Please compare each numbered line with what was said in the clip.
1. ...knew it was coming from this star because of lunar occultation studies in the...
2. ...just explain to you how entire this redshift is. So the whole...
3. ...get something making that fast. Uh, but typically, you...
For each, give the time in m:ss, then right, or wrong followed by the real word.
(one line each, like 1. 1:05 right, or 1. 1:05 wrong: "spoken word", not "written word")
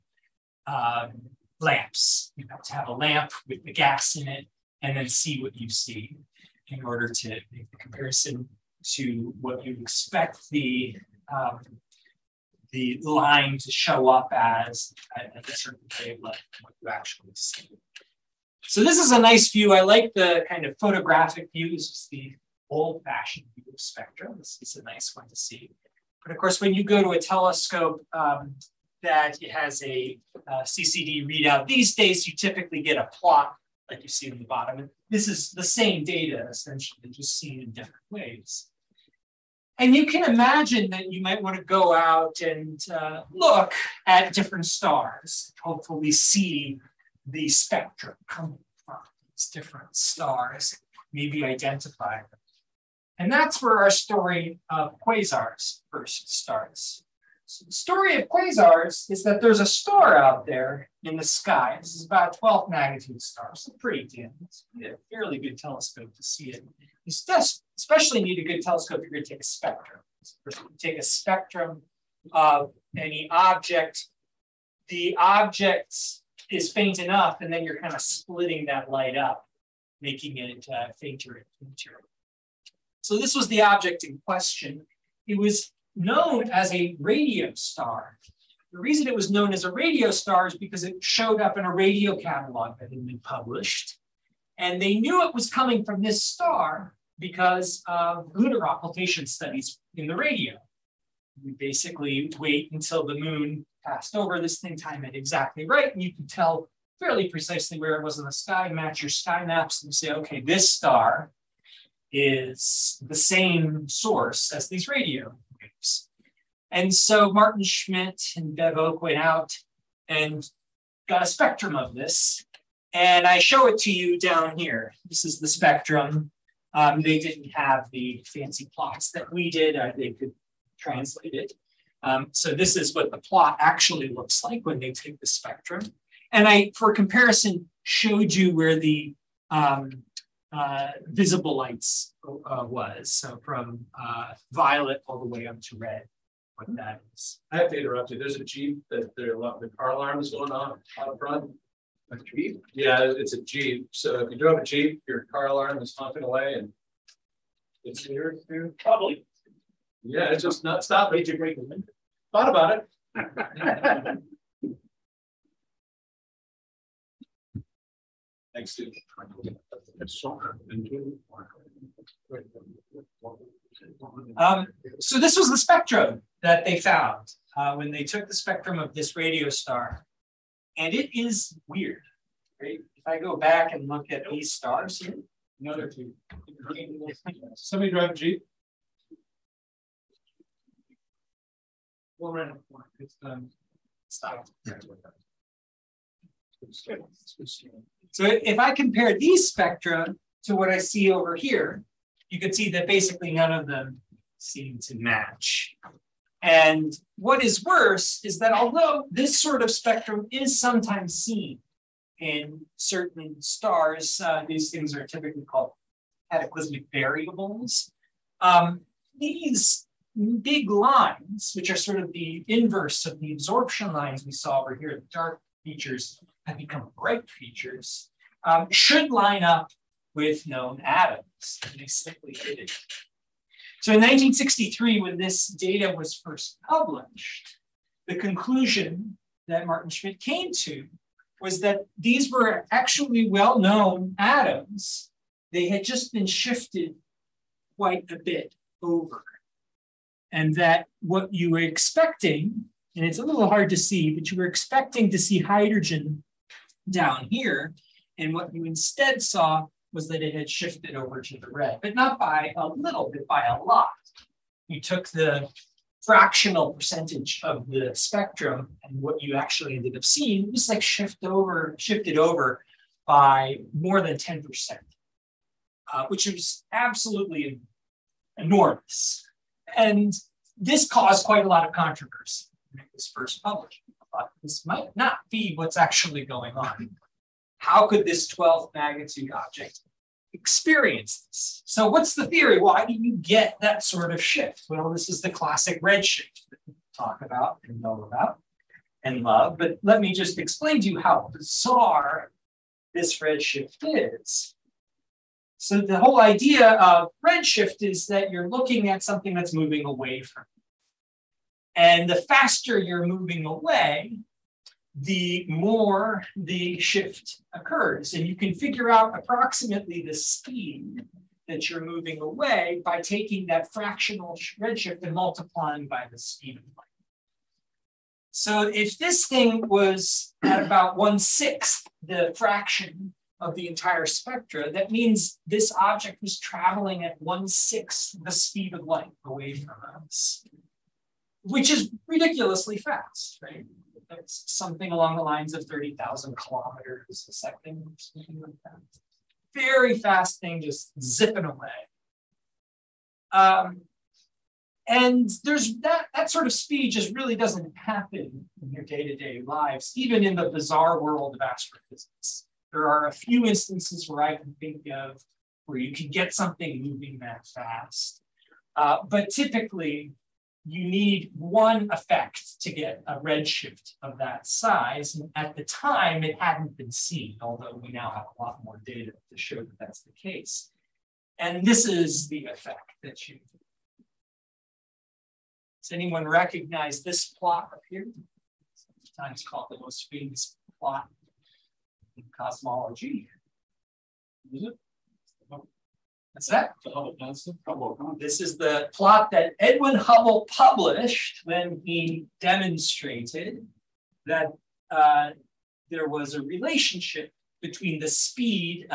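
1. 1:34 right
2. 5:00 wrong: "bizarre", not "entire"
3. 6:06 wrong: "moving", not "making".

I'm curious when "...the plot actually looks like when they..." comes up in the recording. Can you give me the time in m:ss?
2:13.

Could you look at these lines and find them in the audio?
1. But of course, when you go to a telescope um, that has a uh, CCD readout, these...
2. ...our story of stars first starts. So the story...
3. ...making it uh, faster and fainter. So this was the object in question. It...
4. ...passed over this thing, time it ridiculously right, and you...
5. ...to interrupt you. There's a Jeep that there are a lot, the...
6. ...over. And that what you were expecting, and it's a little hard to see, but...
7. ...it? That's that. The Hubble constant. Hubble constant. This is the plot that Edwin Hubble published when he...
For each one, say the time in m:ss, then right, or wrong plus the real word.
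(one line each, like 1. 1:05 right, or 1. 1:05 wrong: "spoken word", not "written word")
1. 0:26 right
2. 0:53 wrong: "quasars", not "stars"
3. 1:20 wrong: "fainter", not "faster"
4. 1:43 wrong: "exactly", not "ridiculously"
5. 2:27 right
6. 4:08 right
7. 6:34 right.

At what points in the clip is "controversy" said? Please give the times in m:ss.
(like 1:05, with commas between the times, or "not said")
4:41.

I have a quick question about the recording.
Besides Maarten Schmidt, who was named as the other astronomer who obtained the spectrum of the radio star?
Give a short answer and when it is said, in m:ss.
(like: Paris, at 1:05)
Bev Oke, at 1:58.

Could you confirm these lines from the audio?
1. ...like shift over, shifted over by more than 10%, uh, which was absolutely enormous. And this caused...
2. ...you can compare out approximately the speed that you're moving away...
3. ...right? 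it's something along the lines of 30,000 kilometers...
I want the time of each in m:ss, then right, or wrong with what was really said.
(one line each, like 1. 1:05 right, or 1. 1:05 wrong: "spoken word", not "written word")
1. 4:30 right
2. 5:18 wrong: "figure", not "compare"
3. 5:43 right.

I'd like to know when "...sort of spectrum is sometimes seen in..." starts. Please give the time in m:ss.
3:29.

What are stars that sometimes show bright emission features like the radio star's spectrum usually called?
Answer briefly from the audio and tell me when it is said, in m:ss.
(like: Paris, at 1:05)
Cataclysmic variables, at 3:36.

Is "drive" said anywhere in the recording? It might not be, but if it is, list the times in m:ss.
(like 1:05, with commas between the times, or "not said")
3:07.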